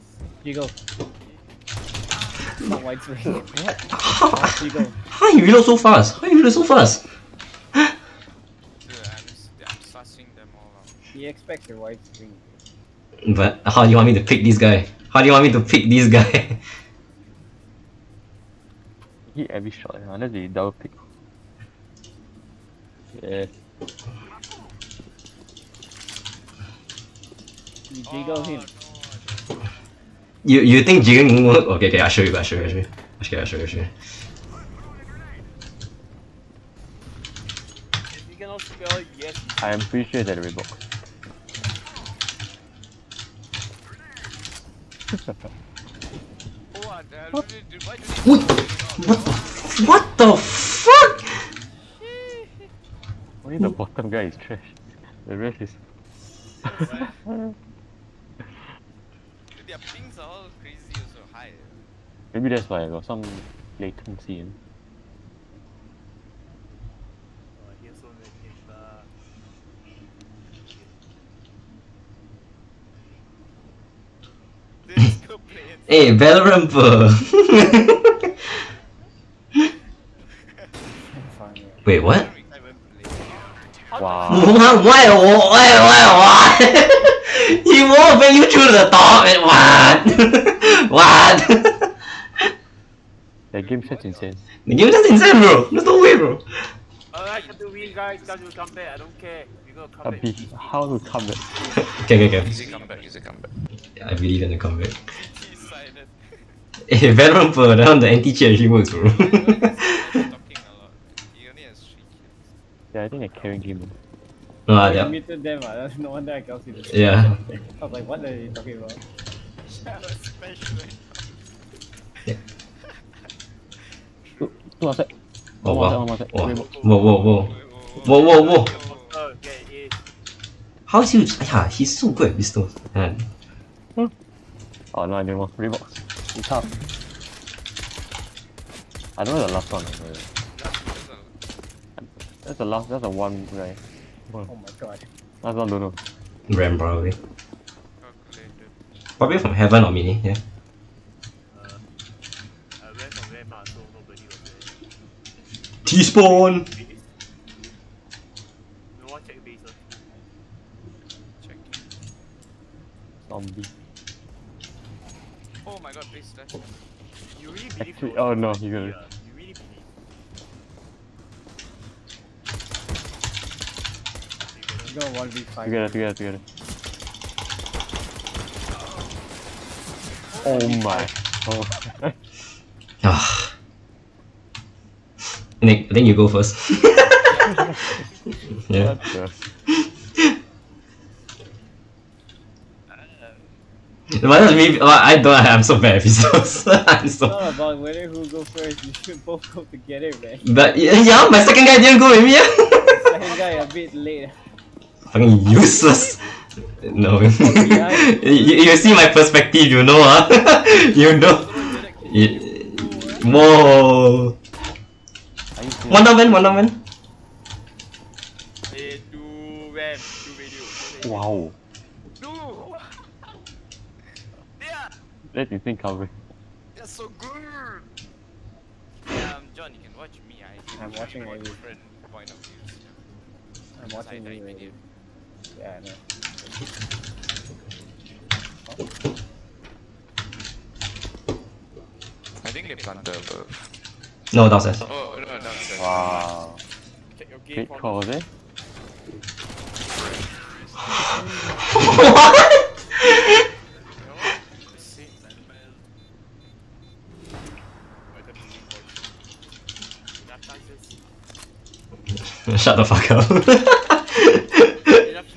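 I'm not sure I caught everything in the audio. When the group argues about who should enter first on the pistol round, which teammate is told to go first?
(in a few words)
Nick.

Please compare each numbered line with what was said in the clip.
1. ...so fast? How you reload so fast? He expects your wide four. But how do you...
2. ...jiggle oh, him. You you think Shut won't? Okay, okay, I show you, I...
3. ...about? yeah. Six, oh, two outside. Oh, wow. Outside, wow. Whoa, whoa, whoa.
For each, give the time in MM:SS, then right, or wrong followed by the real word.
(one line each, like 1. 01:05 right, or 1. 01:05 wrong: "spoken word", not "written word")
1. 00:05 wrong: "three", not "four"
2. 00:28 wrong: "Jigen", not "Shut"
3. 01:58 wrong: "Two", not "Six".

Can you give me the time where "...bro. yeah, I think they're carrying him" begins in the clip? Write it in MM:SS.
01:48.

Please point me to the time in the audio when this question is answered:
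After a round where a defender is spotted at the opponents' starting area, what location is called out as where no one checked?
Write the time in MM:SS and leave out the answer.
02:35.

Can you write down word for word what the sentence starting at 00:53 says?
Only the bottom guy is trash.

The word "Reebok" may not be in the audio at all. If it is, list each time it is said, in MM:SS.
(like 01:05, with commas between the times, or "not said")
00:40, 02:15.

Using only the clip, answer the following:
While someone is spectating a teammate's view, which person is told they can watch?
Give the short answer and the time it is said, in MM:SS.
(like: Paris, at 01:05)
John, at 03:49.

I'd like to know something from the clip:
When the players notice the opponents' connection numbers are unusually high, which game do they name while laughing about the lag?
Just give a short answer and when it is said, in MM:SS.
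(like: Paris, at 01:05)
Valorant, at 01:16.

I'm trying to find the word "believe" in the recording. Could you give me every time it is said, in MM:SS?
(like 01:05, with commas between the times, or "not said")
01:44, 02:47.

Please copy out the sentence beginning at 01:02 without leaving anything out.
Maybe that's why I got some latency oh, in.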